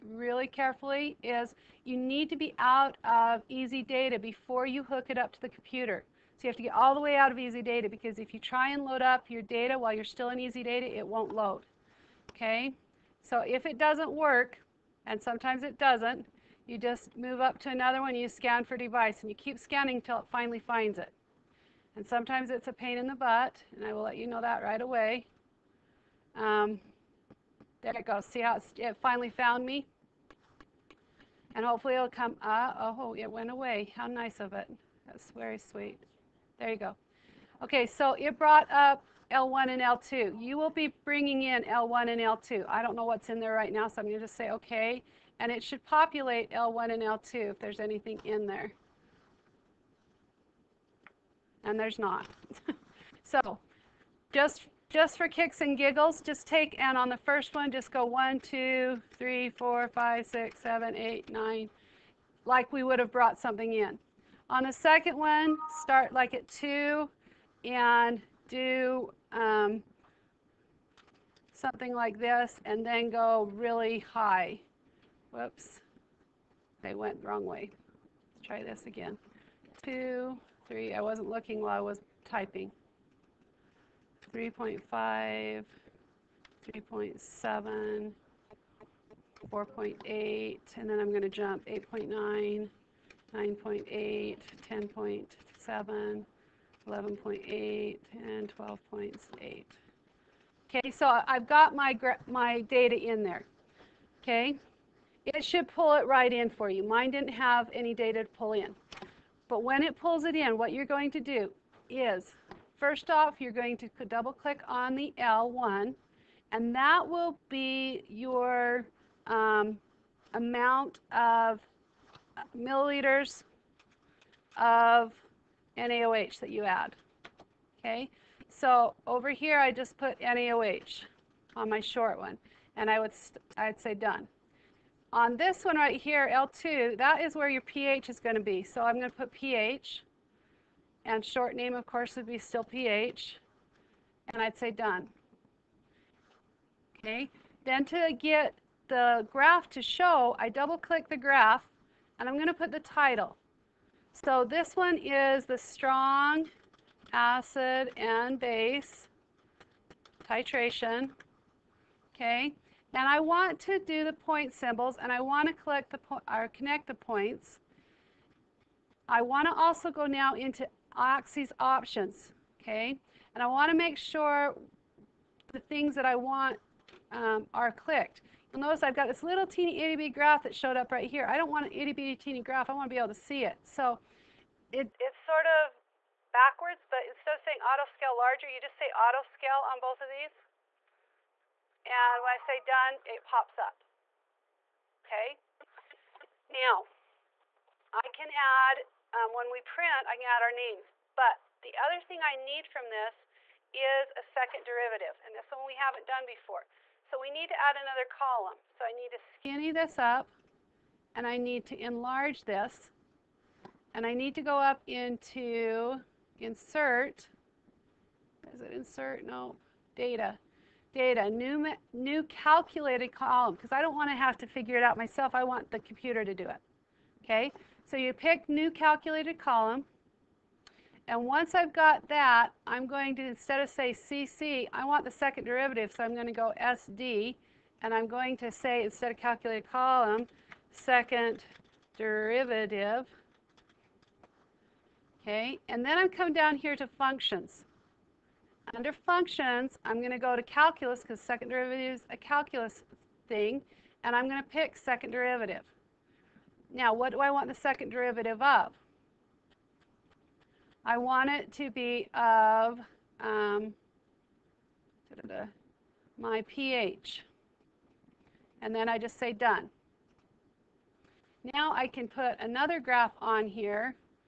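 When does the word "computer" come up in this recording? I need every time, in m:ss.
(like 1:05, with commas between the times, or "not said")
0:05, 3:45.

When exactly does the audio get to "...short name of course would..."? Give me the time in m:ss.
2:21.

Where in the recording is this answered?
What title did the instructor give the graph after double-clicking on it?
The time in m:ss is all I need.
2:35.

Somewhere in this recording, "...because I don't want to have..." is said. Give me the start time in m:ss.
3:43.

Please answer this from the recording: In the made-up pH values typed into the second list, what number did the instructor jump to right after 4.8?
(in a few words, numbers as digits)
8.9.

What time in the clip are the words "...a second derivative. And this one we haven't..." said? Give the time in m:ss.
3:24.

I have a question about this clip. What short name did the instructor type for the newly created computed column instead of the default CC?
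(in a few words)
SD.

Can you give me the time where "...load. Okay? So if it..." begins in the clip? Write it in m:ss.
0:11.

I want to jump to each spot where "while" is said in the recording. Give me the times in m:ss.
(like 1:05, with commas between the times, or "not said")
0:09, 1:21.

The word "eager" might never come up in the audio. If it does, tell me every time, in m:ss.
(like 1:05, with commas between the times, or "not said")
not said.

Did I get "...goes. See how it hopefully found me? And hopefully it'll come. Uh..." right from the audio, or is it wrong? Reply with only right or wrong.
wrong.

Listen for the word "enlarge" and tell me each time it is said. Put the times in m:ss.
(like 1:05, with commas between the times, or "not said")
3:31.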